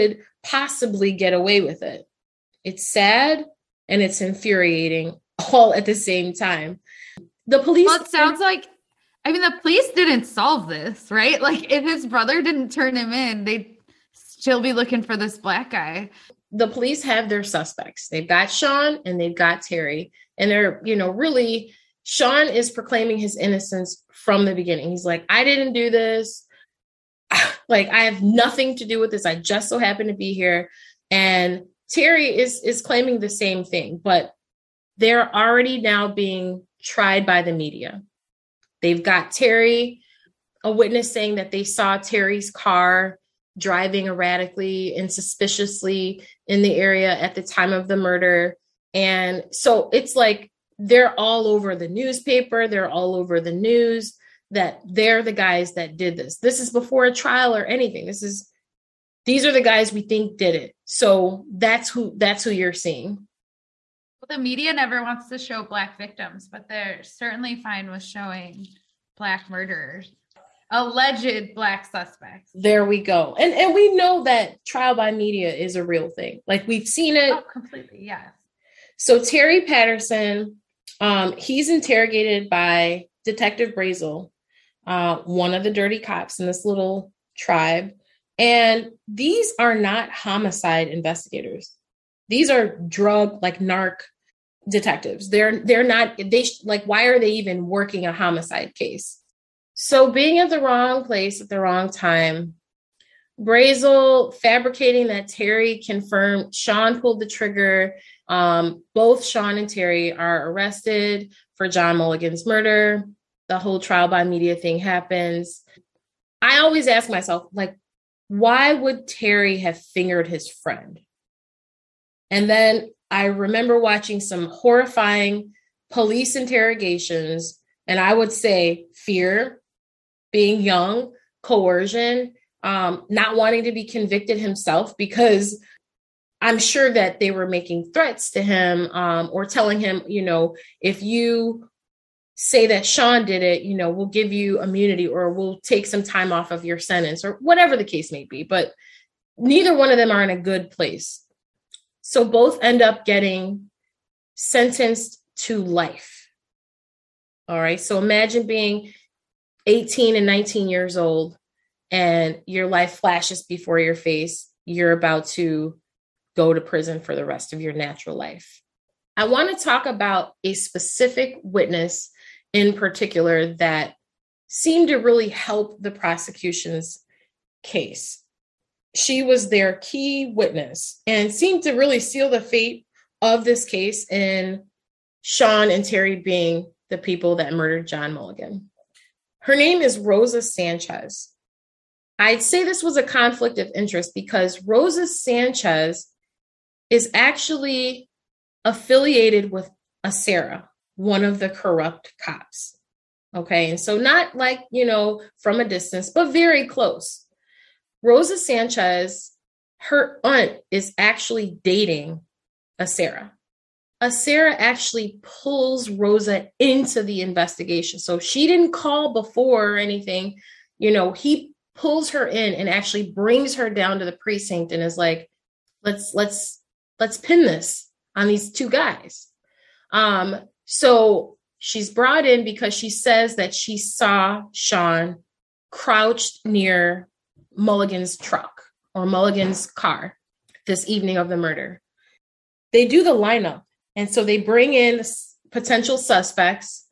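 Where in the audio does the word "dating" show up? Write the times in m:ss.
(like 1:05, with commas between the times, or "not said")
3:31.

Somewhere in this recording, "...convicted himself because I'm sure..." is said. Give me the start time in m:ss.
2:13.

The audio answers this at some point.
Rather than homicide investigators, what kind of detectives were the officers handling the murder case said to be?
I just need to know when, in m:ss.
1:33.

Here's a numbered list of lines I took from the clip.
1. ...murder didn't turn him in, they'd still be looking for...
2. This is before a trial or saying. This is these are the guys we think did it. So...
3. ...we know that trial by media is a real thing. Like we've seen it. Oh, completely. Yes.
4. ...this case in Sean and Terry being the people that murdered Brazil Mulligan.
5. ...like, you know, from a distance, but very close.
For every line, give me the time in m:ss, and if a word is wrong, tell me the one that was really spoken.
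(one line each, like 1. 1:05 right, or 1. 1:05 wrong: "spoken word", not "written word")
1. 0:12 wrong: "brother", not "murder"
2. 0:56 wrong: "anything", not "saying"
3. 1:13 right
4. 3:03 wrong: "John", not "Brazil"
5. 3:24 right.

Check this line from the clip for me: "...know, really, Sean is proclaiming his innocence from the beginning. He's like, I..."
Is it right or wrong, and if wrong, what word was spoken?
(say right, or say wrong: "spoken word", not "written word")
right.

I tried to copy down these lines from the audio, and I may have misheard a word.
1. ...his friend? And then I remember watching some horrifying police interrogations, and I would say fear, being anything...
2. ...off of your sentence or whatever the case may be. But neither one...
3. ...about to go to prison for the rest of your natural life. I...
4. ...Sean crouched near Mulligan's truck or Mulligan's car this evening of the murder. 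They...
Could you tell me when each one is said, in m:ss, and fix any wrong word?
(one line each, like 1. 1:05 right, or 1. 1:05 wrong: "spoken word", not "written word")
1. 2:00 wrong: "young", not "anything"
2. 2:26 right
3. 2:44 right
4. 3:54 right.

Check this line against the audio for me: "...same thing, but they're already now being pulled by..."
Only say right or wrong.
wrong.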